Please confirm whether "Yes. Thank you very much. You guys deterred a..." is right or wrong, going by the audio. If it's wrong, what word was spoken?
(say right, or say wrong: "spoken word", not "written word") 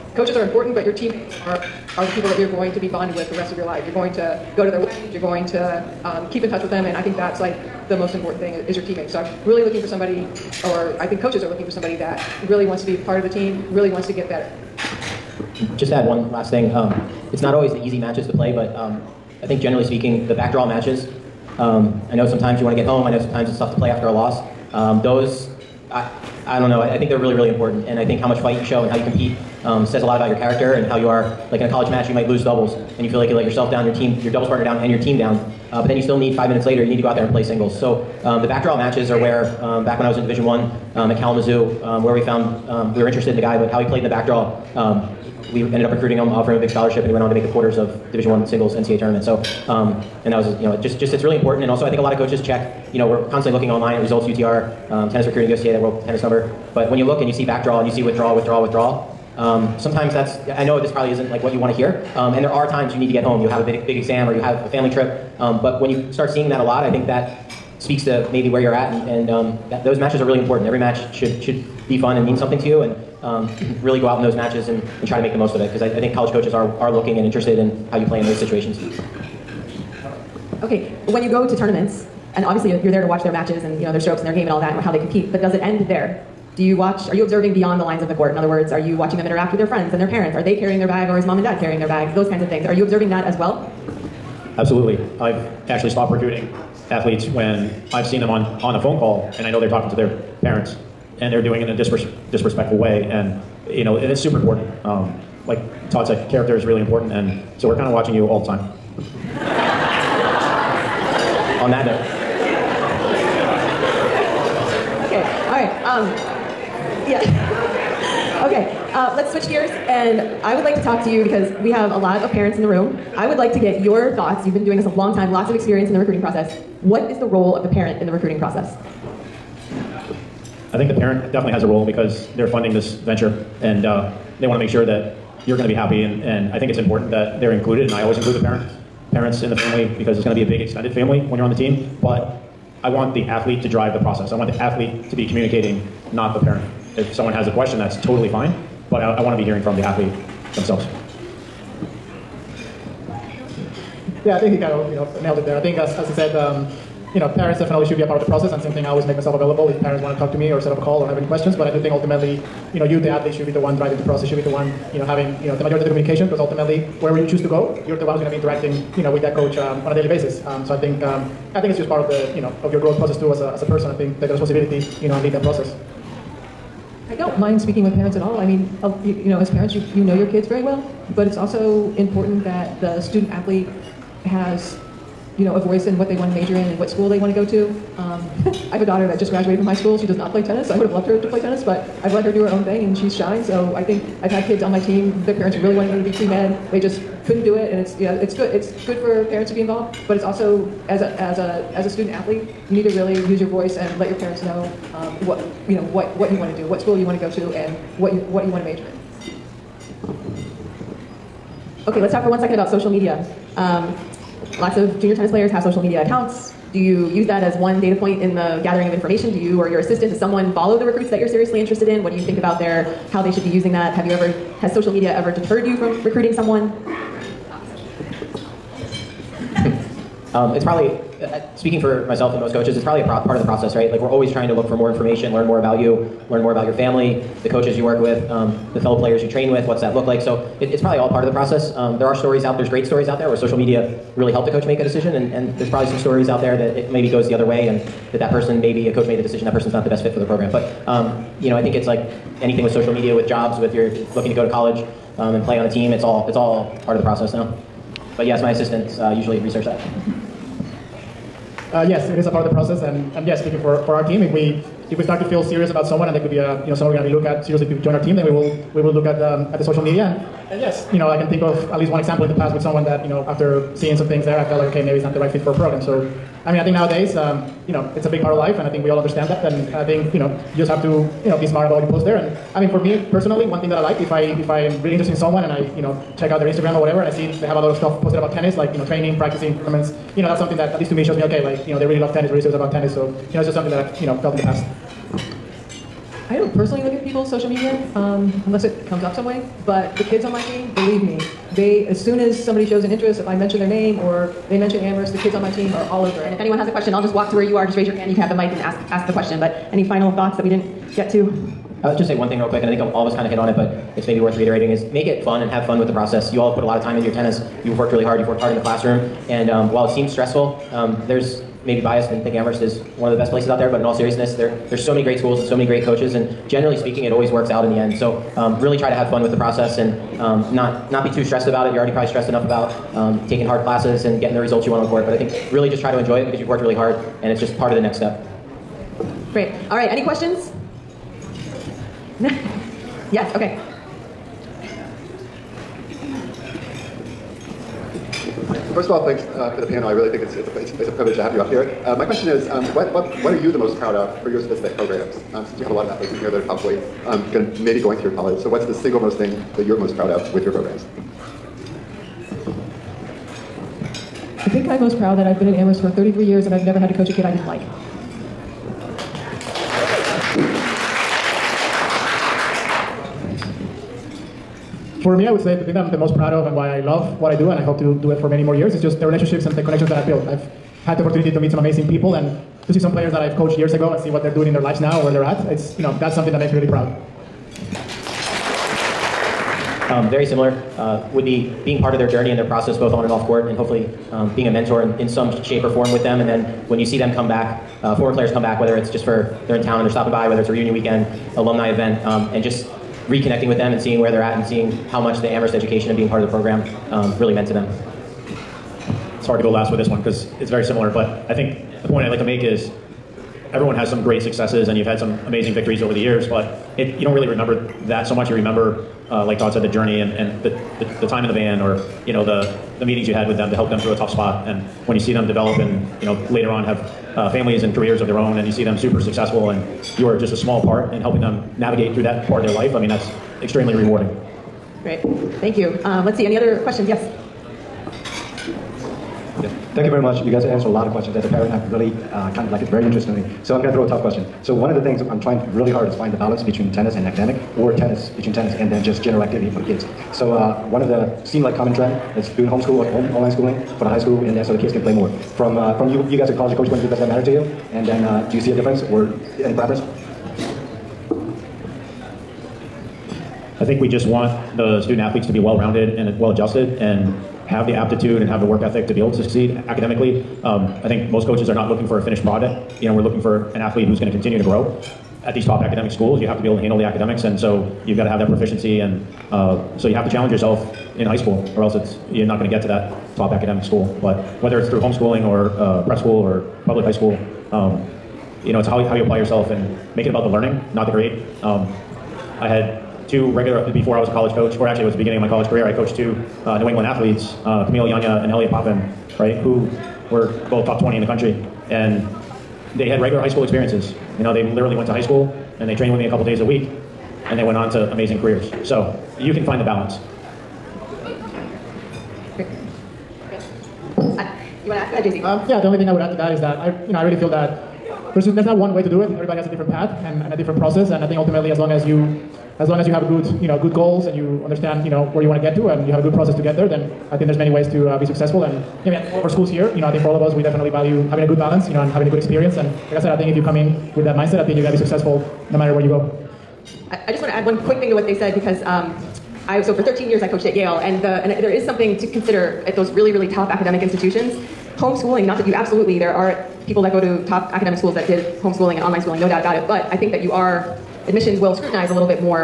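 wrong: "answered", not "deterred".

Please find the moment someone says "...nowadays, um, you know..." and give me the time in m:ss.
4:36.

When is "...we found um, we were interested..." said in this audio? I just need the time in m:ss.
0:42.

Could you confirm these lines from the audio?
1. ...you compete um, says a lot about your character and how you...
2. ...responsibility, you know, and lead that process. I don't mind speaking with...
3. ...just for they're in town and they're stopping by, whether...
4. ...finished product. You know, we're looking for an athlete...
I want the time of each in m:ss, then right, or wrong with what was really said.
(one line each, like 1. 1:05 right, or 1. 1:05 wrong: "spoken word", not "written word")
1. 0:28 right
2. 2:54 right
3. 6:38 right
4. 7:52 right.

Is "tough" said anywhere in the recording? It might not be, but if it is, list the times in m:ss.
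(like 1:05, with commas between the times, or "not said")
0:23, 7:03, 7:23.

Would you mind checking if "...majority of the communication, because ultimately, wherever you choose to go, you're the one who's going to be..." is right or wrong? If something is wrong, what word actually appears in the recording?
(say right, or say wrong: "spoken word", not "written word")
right.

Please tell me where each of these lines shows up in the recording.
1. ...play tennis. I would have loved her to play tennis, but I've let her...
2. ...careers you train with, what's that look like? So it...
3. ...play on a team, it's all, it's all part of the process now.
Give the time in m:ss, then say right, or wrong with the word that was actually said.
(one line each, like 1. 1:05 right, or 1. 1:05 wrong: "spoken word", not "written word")
1. 3:10 right
2. 3:58 wrong: "players", not "careers"
3. 4:15 right.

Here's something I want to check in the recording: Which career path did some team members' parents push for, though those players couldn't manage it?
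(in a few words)
pre-med.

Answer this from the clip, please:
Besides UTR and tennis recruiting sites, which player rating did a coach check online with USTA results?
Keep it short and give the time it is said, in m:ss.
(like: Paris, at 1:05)
world tennis number, at 0:55.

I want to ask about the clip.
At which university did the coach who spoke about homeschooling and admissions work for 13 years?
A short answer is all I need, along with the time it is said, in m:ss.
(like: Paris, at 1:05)
Yale, at 9:00.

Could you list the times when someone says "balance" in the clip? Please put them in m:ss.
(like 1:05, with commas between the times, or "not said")
7:26, 8:29, 8:51.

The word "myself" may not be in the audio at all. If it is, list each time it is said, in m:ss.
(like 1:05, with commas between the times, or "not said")
2:39, 3:52.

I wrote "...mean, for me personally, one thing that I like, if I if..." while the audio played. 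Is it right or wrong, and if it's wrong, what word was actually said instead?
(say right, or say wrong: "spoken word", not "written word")
right.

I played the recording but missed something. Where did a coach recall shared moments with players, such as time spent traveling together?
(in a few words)
the van.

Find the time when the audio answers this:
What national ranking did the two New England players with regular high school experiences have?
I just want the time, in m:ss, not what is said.
8:20.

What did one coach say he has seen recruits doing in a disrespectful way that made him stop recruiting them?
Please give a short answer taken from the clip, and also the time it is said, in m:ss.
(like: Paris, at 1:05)
talking to their parents, at 1:39.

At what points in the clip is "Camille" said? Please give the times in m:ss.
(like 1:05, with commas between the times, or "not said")
8:17.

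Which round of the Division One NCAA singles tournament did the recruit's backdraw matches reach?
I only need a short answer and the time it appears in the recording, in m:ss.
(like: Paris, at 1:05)
quarters, at 0:47.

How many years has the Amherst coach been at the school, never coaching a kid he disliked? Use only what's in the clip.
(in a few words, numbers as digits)
33.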